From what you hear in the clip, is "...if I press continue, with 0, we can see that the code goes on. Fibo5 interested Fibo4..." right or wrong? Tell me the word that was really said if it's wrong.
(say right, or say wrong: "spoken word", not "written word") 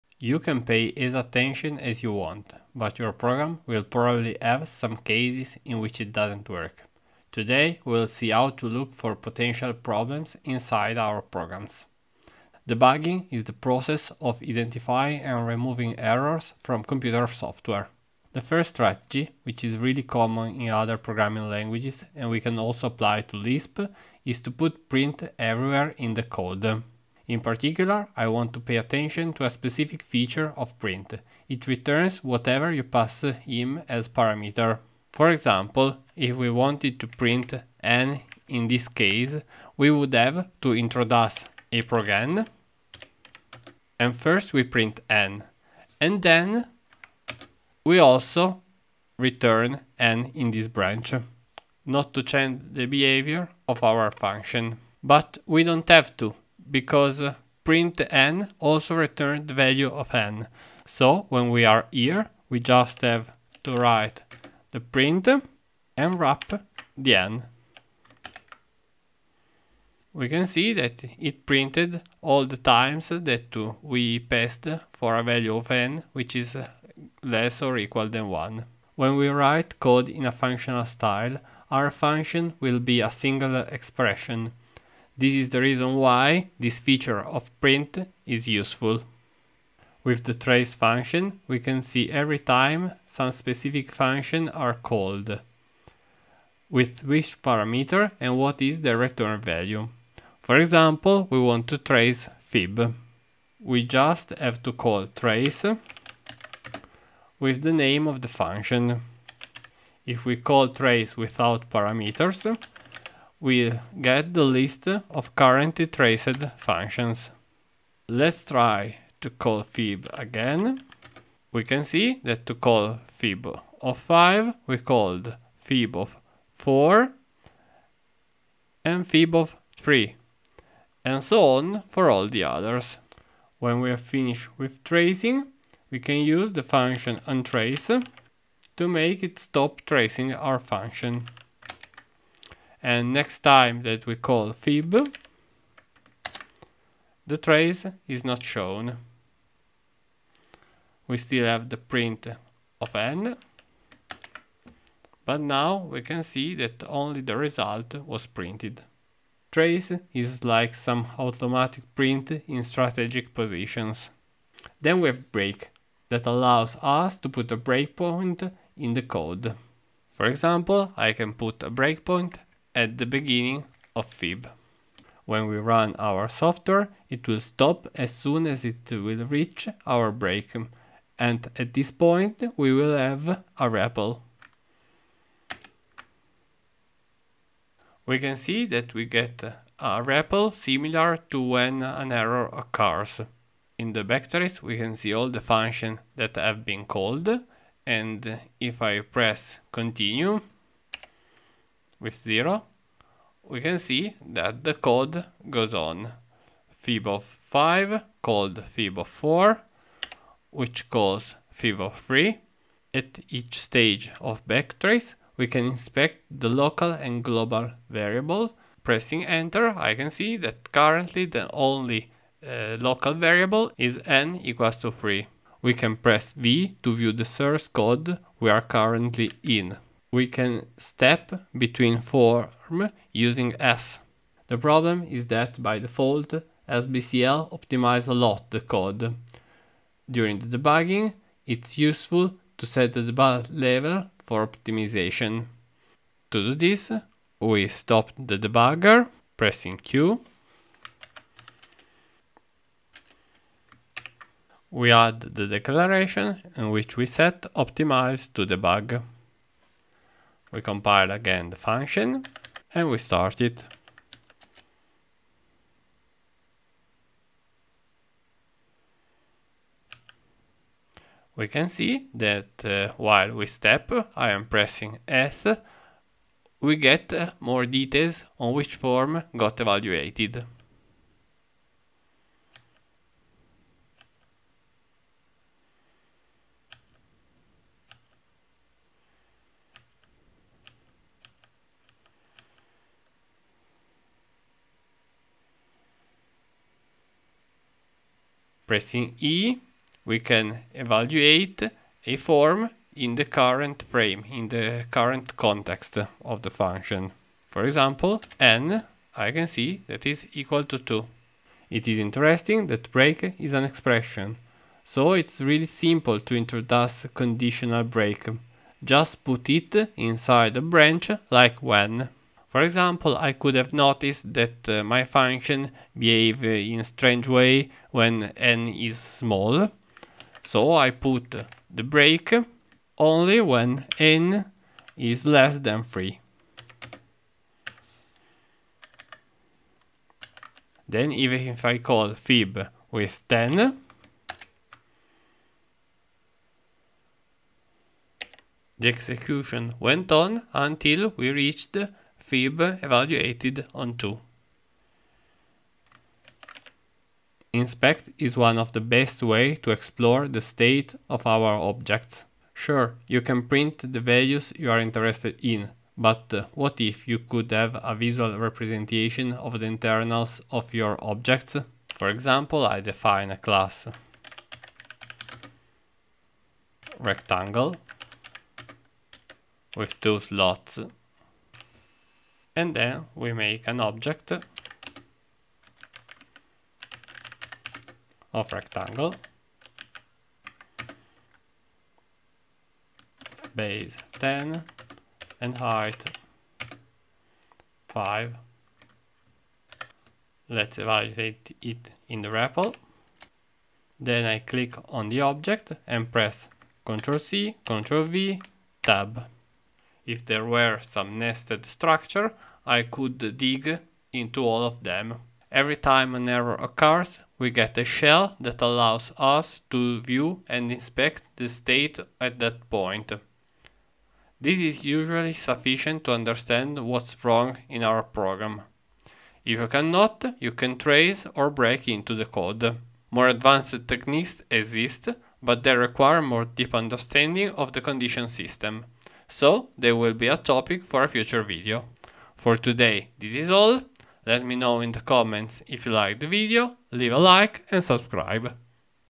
wrong: "called", not "interested".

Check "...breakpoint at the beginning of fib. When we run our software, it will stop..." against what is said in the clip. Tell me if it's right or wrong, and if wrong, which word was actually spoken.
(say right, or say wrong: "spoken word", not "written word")
right.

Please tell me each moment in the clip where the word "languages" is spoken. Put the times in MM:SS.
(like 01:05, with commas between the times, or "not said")
00:21.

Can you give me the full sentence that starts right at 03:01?
And at this point, we will have a REPL.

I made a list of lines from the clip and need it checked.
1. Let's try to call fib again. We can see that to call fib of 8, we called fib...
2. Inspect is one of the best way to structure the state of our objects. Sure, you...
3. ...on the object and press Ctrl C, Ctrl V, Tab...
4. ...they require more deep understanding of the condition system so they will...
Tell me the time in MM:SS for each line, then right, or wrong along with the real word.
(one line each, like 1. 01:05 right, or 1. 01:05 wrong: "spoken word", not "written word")
1. 01:58 wrong: "5", not "8"
2. 05:57 wrong: "explore", not "structure"
3. 06:44 right
4. 07:15 right.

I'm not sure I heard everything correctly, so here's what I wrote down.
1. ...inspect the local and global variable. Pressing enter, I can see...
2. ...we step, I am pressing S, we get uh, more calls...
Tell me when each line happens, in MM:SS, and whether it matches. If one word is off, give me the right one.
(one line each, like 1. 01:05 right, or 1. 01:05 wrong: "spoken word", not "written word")
1. 03:35 right
2. 04:33 wrong: "details", not "calls".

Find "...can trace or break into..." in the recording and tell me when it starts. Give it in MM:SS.
07:10.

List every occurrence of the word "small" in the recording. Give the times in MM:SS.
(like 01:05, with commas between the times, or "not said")
05:28.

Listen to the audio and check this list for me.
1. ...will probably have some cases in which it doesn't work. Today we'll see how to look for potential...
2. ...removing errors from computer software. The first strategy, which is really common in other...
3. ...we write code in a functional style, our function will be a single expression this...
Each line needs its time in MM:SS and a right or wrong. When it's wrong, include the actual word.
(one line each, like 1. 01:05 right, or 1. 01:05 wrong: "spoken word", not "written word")
1. 00:03 right
2. 00:15 right
3. 01:19 right.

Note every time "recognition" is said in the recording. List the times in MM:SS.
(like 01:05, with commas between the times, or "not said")
not said.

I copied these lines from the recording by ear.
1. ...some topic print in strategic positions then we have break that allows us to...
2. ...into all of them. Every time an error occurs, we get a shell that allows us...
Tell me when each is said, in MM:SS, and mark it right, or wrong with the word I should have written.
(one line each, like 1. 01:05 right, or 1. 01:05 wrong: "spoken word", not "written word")
1. 02:40 wrong: "automatic", not "topic"
2. 06:54 right.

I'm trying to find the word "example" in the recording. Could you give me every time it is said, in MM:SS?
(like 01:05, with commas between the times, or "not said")
00:35, 01:40, 02:50, 05:07, 05:22, 06:12.